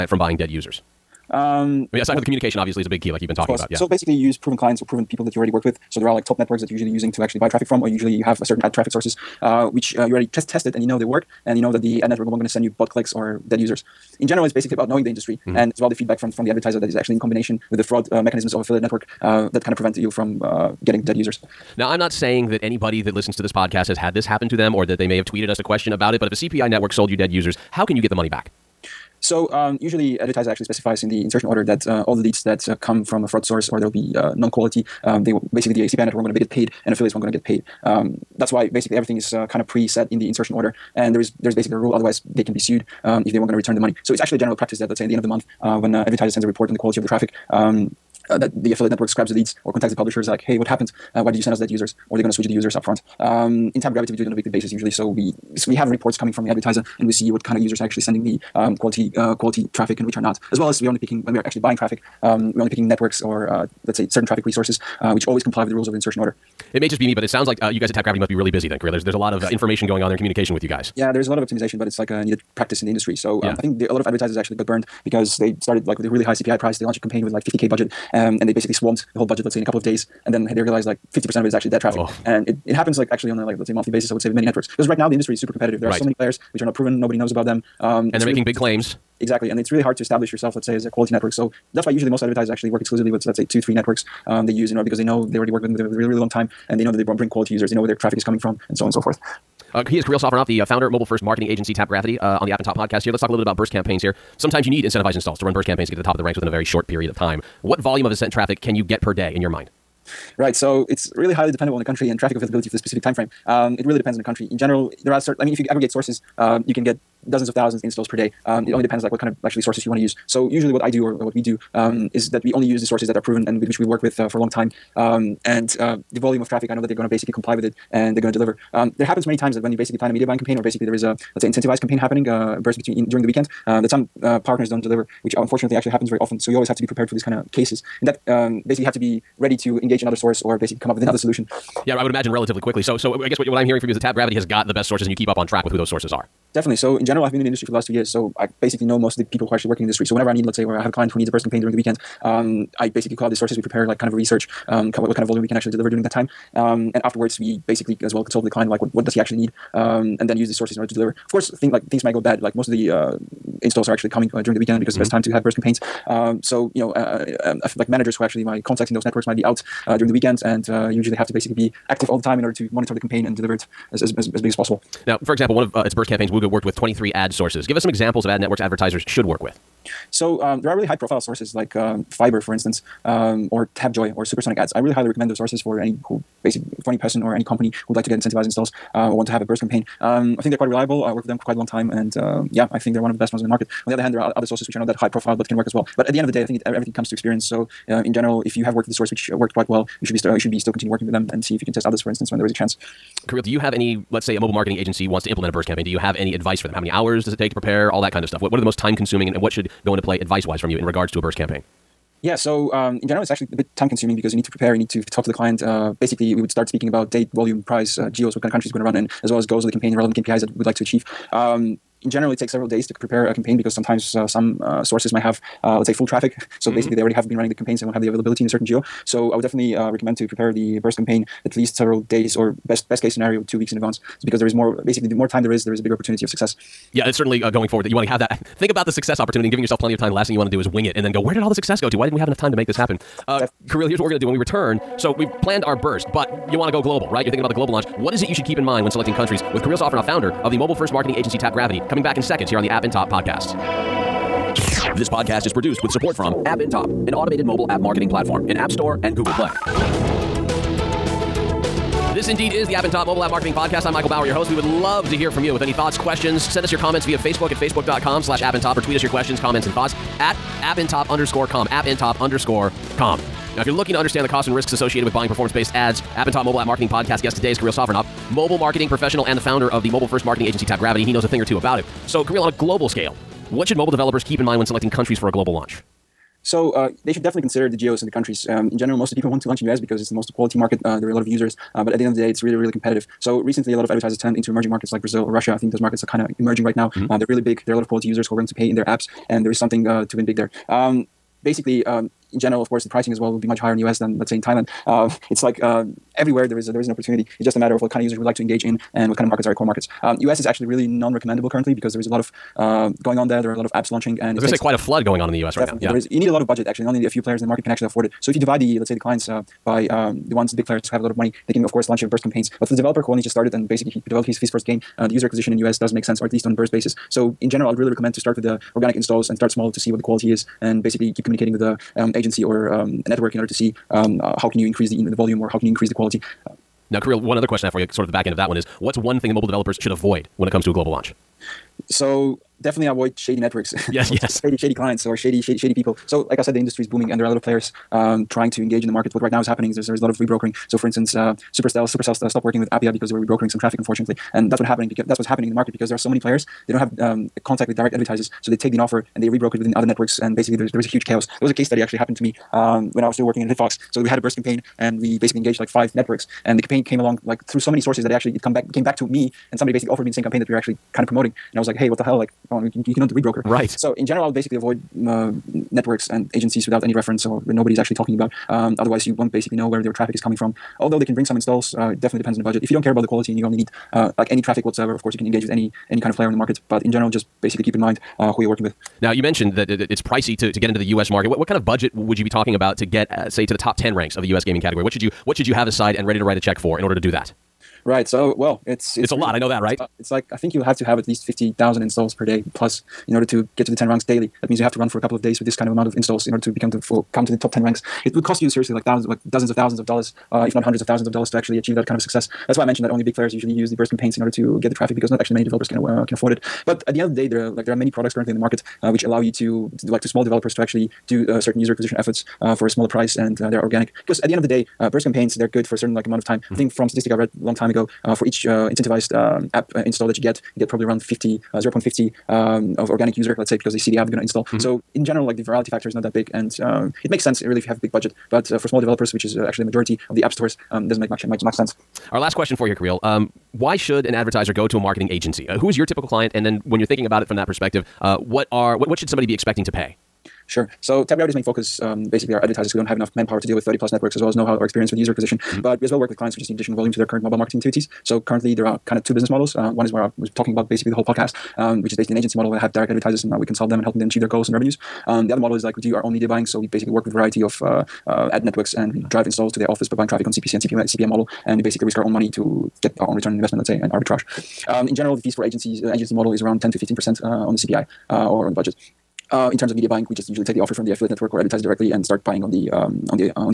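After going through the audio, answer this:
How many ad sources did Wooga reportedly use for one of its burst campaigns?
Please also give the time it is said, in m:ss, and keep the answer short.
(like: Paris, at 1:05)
23, at 2:56.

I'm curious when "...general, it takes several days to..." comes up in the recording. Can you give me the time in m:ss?
3:42.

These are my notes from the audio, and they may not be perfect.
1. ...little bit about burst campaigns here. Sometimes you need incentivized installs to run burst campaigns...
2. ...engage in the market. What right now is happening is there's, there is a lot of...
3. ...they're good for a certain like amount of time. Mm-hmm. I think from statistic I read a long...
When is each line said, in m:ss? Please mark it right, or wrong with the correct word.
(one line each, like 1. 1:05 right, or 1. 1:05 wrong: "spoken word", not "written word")
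1. 1:43 right
2. 5:48 right
3. 7:05 right.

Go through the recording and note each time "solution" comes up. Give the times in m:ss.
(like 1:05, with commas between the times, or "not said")
2:21.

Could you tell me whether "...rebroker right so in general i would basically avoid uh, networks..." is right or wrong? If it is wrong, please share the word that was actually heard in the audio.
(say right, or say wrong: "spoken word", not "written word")
right.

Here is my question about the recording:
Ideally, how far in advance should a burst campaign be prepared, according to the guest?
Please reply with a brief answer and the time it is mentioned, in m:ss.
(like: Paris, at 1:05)
Two weeks, at 3:53.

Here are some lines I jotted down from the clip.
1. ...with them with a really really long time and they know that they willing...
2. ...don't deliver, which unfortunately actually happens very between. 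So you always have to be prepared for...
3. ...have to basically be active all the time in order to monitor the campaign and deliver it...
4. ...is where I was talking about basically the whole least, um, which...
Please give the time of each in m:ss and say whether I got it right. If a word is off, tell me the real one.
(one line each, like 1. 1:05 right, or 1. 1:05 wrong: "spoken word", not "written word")
1. 1:35 wrong: "bring", not "willing"
2. 2:14 wrong: "often", not "between"
3. 2:51 right
4. 7:39 wrong: "podcast", not "least".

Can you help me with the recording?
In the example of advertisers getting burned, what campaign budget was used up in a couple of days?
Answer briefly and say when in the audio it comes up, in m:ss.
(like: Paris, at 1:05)
50k, at 1:17.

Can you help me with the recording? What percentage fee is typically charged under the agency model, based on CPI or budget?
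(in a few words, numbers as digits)
10 to 15 percent.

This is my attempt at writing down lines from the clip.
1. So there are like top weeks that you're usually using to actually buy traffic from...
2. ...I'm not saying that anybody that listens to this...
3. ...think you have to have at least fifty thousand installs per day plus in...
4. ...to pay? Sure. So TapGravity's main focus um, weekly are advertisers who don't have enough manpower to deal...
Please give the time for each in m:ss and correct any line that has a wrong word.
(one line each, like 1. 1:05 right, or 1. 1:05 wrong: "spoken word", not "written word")
1. 0:05 wrong: "networks", not "weeks"
2. 0:21 right
3. 6:40 right
4. 7:29 wrong: "basically", not "weekly".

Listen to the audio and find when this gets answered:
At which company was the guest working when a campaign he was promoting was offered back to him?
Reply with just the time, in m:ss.
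6:03.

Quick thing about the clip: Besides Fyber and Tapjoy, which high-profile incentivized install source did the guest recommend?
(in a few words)
Supersonic Ads.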